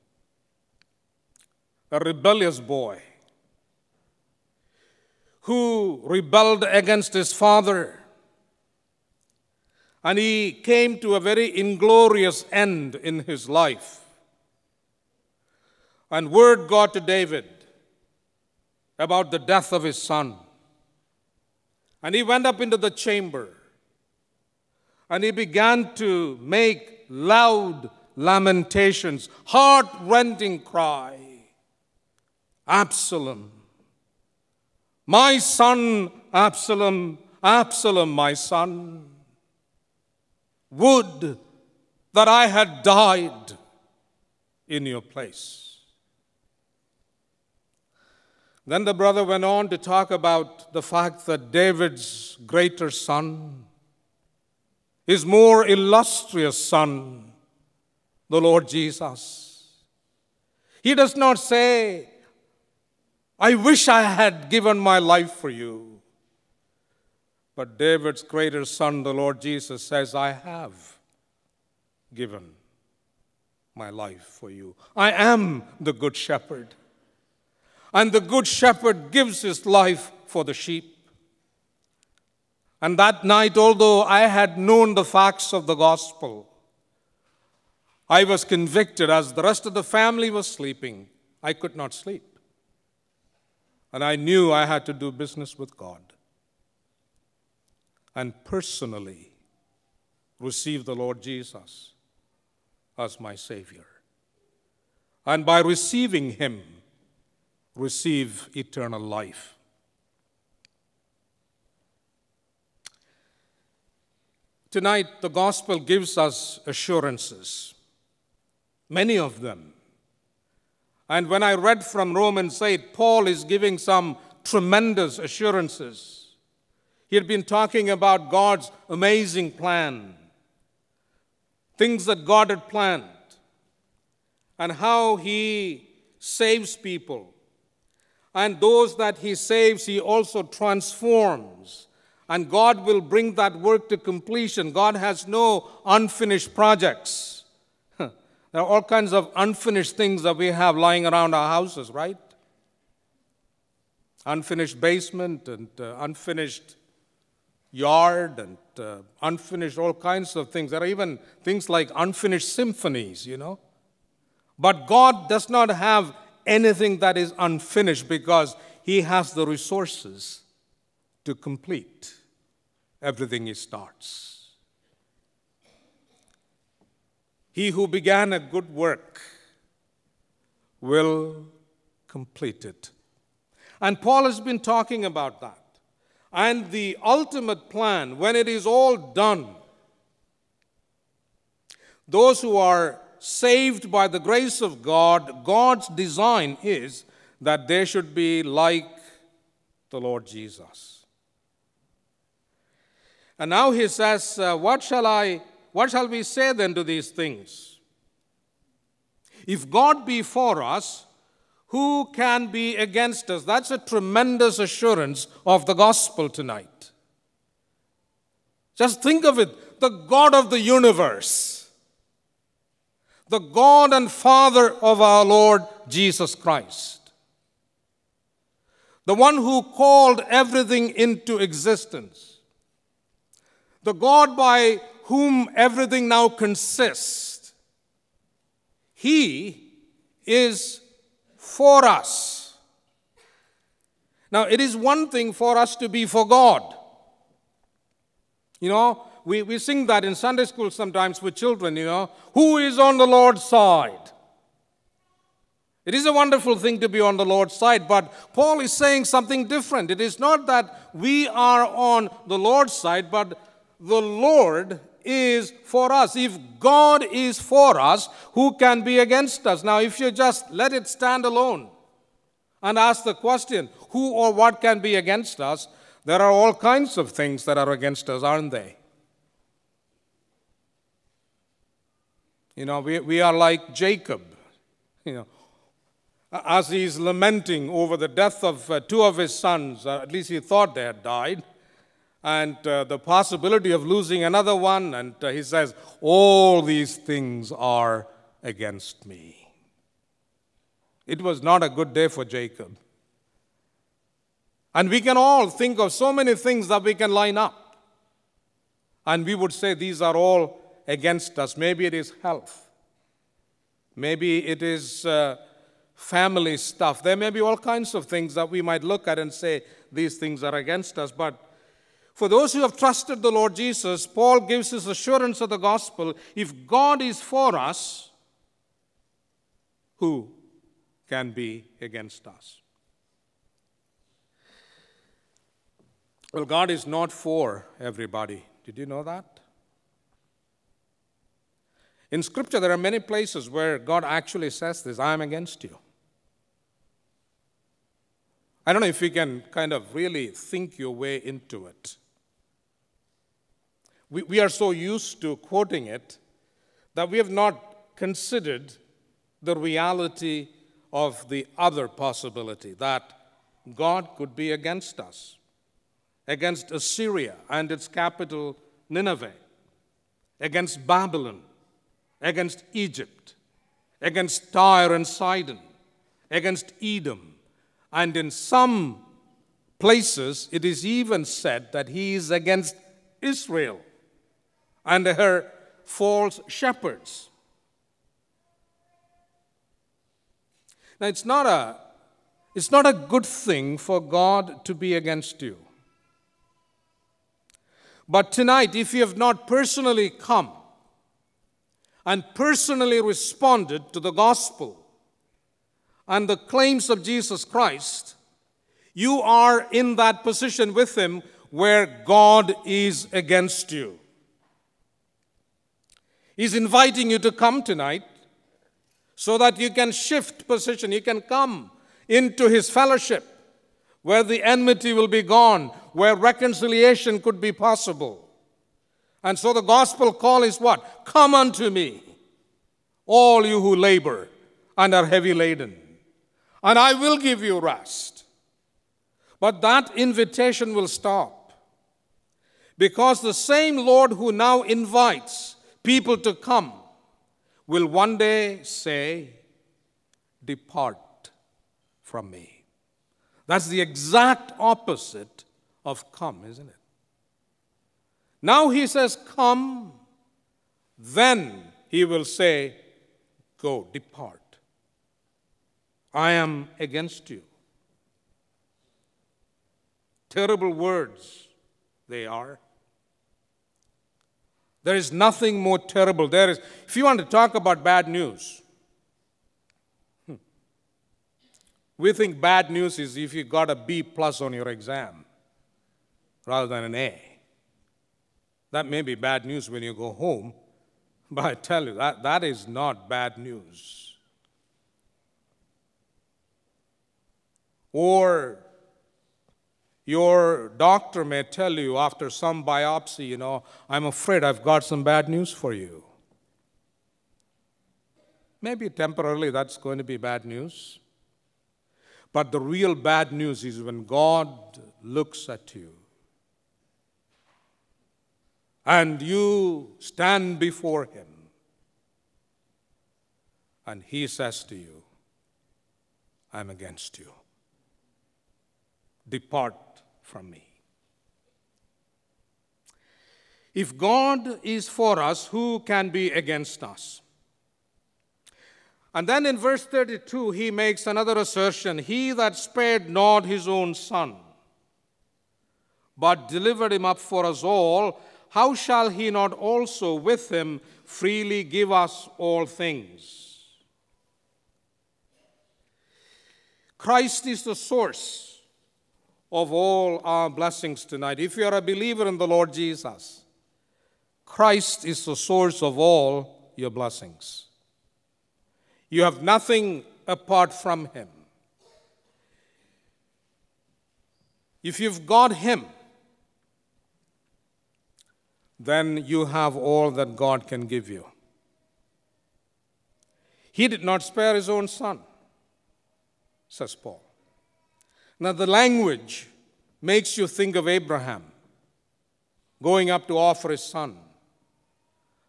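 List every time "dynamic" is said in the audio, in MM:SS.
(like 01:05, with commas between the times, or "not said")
not said.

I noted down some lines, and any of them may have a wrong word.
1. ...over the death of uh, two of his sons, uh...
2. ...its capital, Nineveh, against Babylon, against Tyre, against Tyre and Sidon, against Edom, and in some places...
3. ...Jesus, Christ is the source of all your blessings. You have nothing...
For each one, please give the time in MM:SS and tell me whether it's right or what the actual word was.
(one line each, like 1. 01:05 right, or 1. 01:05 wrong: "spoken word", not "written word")
1. 04:47 right
2. 06:07 wrong: "Egypt", not "Tyre"
3. 09:22 right.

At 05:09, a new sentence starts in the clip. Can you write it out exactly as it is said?
And we would say, These are all against us.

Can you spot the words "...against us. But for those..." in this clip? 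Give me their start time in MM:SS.
05:20.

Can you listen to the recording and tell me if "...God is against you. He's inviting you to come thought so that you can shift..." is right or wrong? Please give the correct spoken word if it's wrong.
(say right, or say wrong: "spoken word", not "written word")
wrong: "tonight", not "thought".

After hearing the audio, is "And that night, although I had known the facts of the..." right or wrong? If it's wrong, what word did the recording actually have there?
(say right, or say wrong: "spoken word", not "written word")
right.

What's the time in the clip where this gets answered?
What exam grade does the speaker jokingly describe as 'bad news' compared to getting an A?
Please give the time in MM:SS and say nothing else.
08:03.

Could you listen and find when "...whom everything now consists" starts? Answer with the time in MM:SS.
03:55.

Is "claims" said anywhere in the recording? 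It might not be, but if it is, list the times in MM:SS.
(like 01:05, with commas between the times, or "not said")
06:46.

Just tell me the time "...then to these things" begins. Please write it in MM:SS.
03:26.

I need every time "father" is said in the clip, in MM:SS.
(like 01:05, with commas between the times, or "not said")
00:07, 03:44.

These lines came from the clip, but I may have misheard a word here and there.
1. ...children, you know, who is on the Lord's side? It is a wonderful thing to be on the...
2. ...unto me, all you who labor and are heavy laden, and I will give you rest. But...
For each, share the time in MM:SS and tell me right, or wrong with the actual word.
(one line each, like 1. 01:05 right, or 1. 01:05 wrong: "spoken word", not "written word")
1. 04:11 right
2. 07:11 right.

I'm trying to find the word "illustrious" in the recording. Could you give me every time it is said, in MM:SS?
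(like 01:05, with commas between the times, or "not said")
00:55.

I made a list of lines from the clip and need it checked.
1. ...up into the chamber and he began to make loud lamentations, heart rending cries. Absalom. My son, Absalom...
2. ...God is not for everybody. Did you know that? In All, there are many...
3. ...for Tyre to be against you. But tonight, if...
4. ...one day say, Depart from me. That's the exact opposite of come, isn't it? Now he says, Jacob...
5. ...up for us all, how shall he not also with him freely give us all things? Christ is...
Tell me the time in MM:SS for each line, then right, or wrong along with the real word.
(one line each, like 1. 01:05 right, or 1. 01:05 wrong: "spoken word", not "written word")
1. 00:22 right
2. 05:36 wrong: "Scripture", not "All"
3. 06:33 wrong: "God", not "Tyre"
4. 07:28 wrong: "Come", not "Jacob"
5. 09:07 right.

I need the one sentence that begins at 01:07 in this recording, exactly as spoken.
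But David's greater son, the Lord Jesus, says, I have given my life for you.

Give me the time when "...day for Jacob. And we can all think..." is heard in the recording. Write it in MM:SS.
05:01.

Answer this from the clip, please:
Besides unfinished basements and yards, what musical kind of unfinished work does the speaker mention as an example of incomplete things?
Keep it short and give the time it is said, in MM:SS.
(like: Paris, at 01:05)
unfinished symphonies, at 02:41.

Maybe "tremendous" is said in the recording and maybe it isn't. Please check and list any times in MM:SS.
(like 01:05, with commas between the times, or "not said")
02:04, 03:33.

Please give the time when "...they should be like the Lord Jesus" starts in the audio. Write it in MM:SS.
03:17.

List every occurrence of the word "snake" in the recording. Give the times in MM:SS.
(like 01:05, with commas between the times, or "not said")
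not said.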